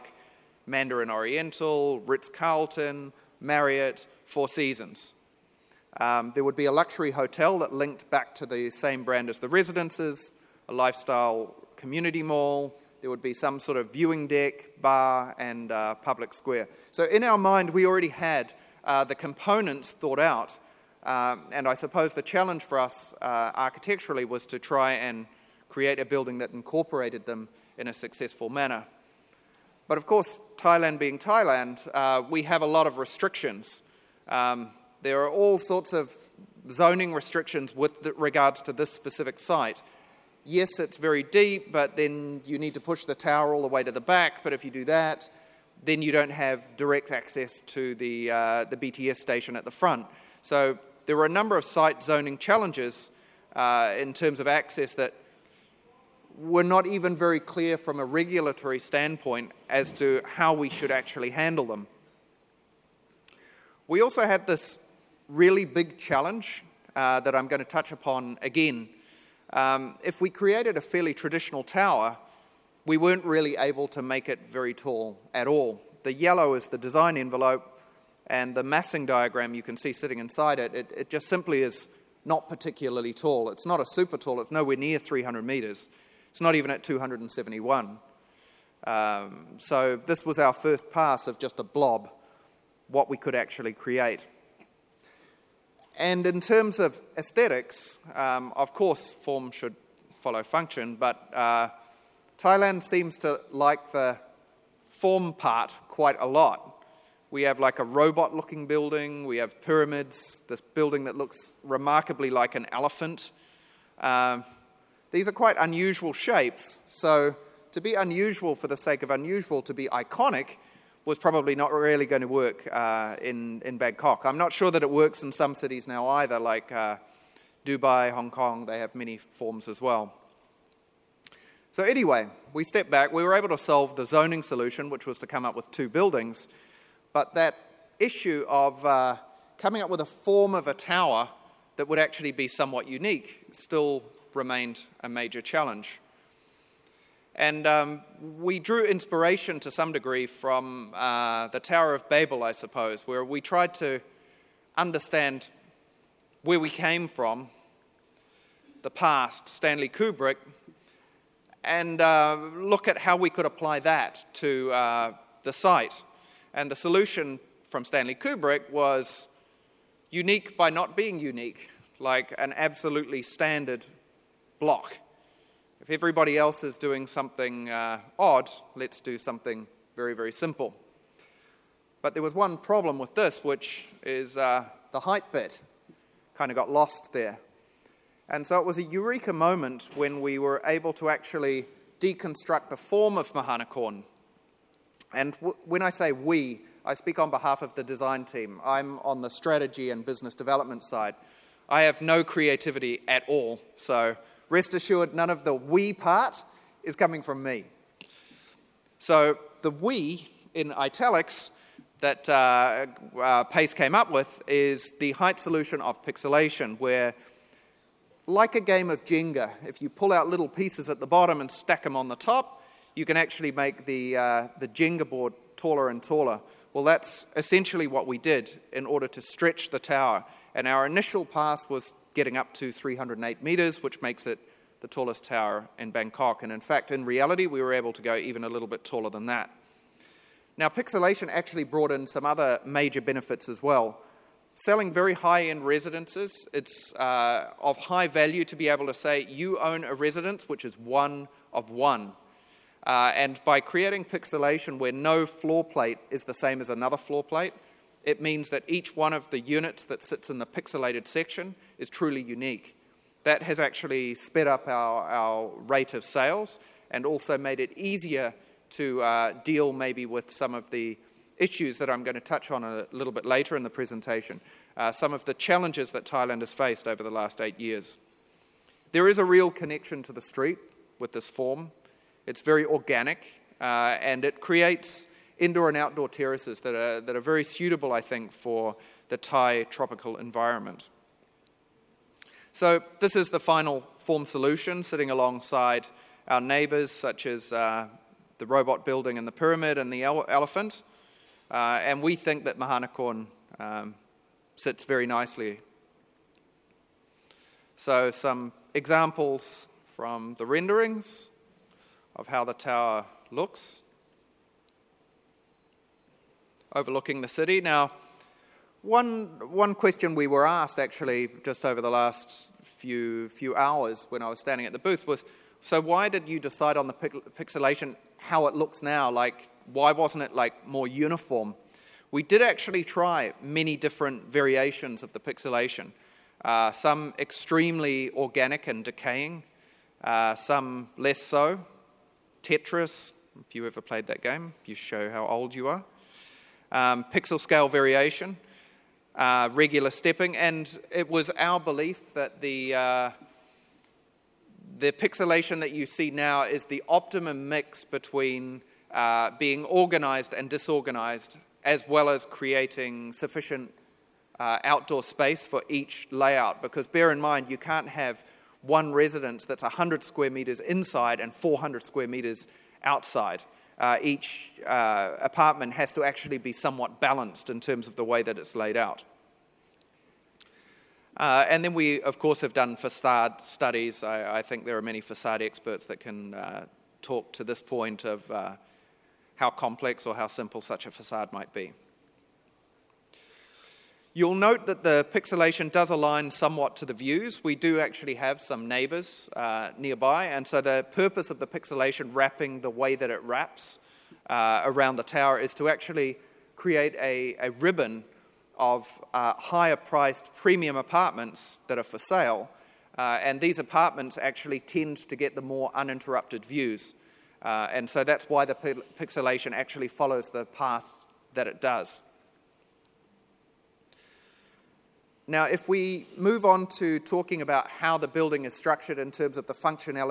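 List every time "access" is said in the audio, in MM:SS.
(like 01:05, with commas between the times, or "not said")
00:47, 00:54.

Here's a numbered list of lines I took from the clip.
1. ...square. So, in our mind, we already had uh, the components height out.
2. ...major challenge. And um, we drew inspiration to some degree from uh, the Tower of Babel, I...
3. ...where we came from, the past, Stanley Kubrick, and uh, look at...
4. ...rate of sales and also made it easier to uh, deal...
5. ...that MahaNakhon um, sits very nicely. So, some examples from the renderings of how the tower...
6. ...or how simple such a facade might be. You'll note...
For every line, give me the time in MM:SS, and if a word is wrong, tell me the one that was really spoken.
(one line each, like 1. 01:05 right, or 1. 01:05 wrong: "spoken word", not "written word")
1. 00:16 wrong: "thought", not "height"
2. 02:25 right
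3. 02:36 right
4. 04:25 right
5. 05:02 right
6. 06:30 right.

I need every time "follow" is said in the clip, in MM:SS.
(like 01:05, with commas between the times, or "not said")
01:40, 06:59.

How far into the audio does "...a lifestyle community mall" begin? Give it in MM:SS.
00:10.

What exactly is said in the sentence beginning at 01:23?
It's not a super tall, it's nowhere near 300 meters.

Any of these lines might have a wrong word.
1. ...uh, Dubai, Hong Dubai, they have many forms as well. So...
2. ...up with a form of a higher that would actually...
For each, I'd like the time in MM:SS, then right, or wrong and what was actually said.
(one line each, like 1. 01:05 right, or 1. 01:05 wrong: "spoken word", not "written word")
1. 02:06 wrong: "Kong", not "Dubai"
2. 02:19 wrong: "tower", not "higher".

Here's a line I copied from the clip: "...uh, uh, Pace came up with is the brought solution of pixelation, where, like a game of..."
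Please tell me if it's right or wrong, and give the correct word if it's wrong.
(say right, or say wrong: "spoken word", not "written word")
wrong: "height", not "brought".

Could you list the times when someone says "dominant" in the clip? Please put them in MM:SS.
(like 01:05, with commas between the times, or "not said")
not said.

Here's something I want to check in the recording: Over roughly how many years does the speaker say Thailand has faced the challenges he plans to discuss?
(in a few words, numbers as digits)
8 years.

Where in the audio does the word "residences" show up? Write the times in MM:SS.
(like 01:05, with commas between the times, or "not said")
00:09, 04:05, 04:09, 06:08.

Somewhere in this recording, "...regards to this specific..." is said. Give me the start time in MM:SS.
00:38.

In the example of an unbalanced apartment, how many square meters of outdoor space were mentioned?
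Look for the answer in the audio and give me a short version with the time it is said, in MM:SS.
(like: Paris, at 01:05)
400 square meters, at 06:11.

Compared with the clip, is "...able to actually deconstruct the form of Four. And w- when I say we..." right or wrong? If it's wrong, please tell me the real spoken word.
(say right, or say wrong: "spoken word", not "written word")
wrong: "MahaNakhon", not "Four".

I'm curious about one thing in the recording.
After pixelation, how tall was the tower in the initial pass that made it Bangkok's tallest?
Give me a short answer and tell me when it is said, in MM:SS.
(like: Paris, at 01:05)
308 metres, at 03:52.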